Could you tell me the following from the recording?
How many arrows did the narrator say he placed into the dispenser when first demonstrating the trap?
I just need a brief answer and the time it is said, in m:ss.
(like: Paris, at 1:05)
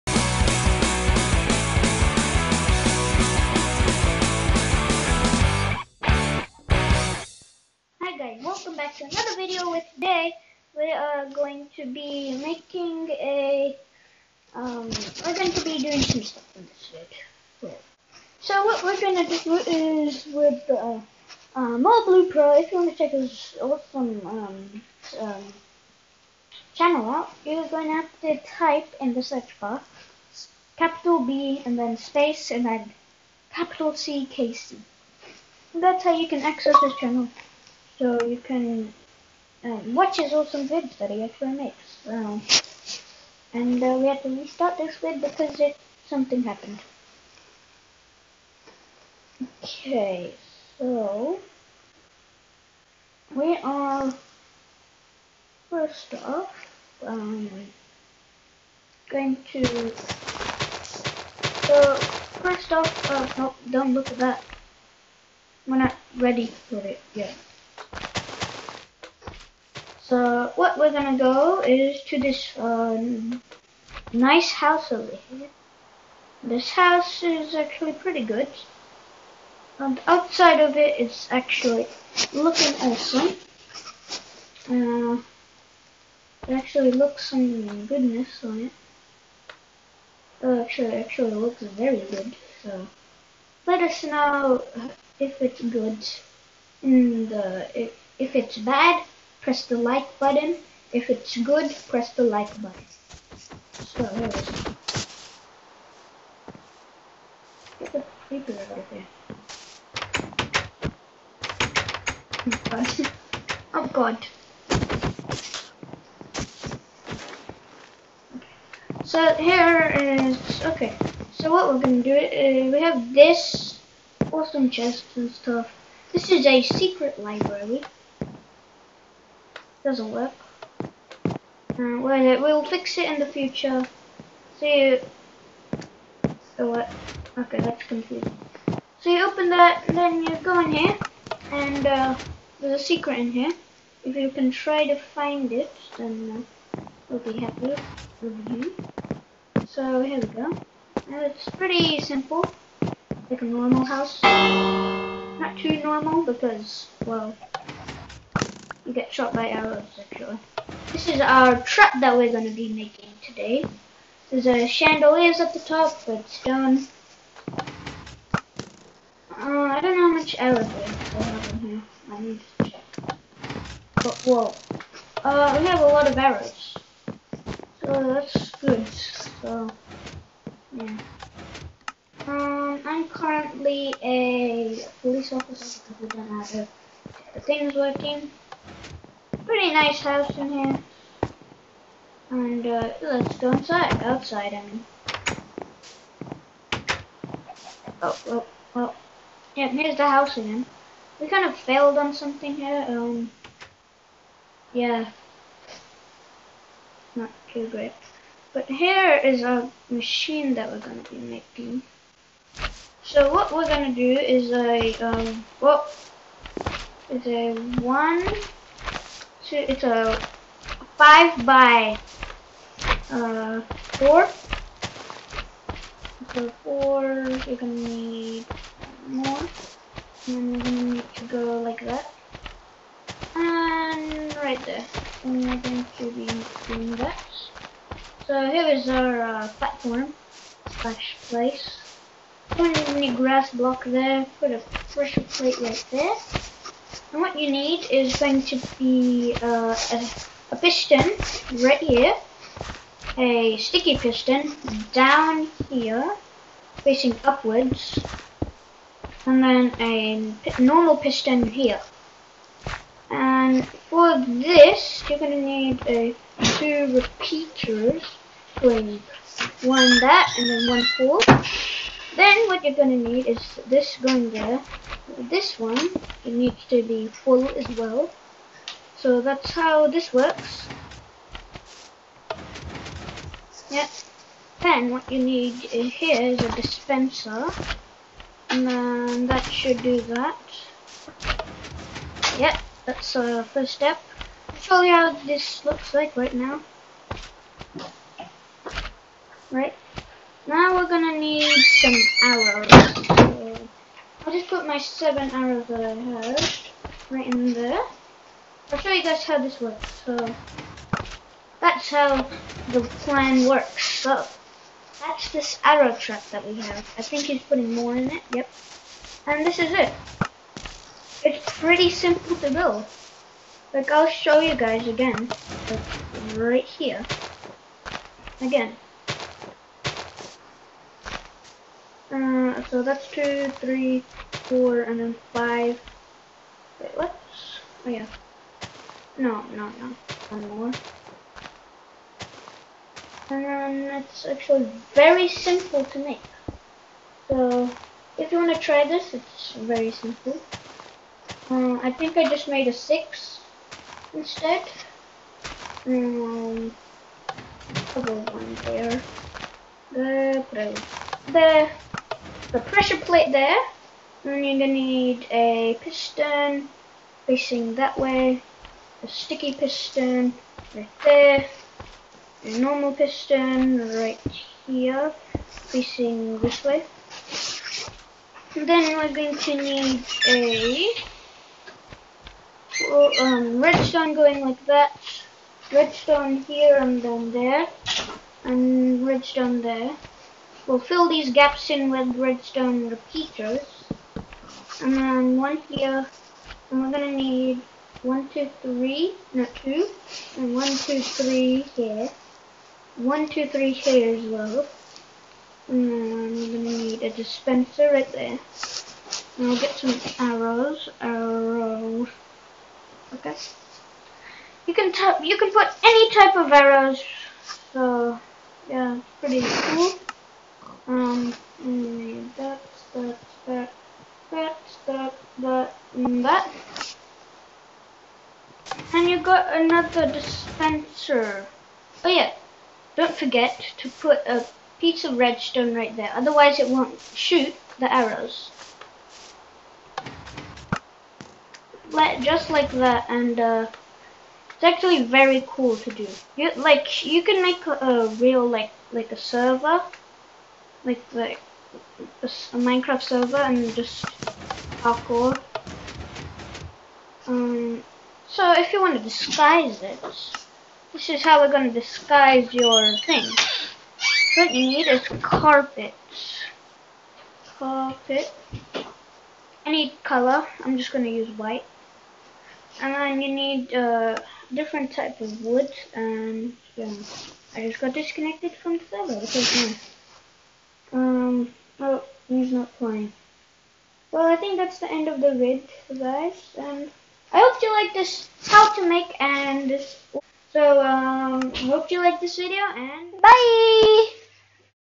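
7, at 5:04.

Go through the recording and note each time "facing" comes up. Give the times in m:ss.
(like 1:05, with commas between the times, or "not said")
4:16, 6:07, 6:15.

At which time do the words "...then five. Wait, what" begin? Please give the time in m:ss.
5:34.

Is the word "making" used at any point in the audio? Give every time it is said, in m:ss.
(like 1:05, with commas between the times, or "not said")
0:12, 2:42, 3:31.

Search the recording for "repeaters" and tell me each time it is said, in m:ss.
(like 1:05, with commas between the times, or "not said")
4:26, 6:32.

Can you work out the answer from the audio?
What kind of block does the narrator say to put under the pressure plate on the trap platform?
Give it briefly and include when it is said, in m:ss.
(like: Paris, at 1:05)
grass block, at 4:03.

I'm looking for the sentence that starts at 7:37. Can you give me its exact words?
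Um, so if you want to disguise it, this is how we're going to disguise your thing.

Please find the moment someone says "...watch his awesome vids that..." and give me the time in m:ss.
0:39.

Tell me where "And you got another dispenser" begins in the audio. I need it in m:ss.
7:08.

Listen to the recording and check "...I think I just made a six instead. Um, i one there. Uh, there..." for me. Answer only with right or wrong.
right.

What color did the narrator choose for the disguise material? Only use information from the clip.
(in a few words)
white.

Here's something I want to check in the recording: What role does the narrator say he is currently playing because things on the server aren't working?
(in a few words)
police officer.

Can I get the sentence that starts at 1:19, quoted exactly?
And outside of it, it's actually looking awesome.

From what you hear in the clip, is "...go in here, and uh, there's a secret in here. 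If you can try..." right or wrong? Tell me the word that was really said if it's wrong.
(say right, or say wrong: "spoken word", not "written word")
right.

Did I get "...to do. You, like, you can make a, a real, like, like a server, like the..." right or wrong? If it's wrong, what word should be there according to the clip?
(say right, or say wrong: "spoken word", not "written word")
right.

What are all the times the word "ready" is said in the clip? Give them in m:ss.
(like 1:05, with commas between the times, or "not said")
1:06.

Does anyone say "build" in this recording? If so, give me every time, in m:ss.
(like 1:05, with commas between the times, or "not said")
5:22.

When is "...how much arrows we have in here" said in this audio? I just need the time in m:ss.
2:50.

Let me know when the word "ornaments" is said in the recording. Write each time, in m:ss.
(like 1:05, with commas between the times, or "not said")
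not said.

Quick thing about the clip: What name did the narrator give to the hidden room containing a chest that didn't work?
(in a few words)
secret library.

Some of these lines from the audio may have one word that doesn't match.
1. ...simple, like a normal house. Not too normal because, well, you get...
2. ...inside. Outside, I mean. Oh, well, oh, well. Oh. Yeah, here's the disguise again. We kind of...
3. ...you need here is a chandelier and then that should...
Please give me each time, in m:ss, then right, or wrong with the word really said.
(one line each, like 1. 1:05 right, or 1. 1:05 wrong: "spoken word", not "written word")
1. 2:32 right
2. 3:13 wrong: "house", not "disguise"
3. 4:45 wrong: "dispenser", not "chandelier".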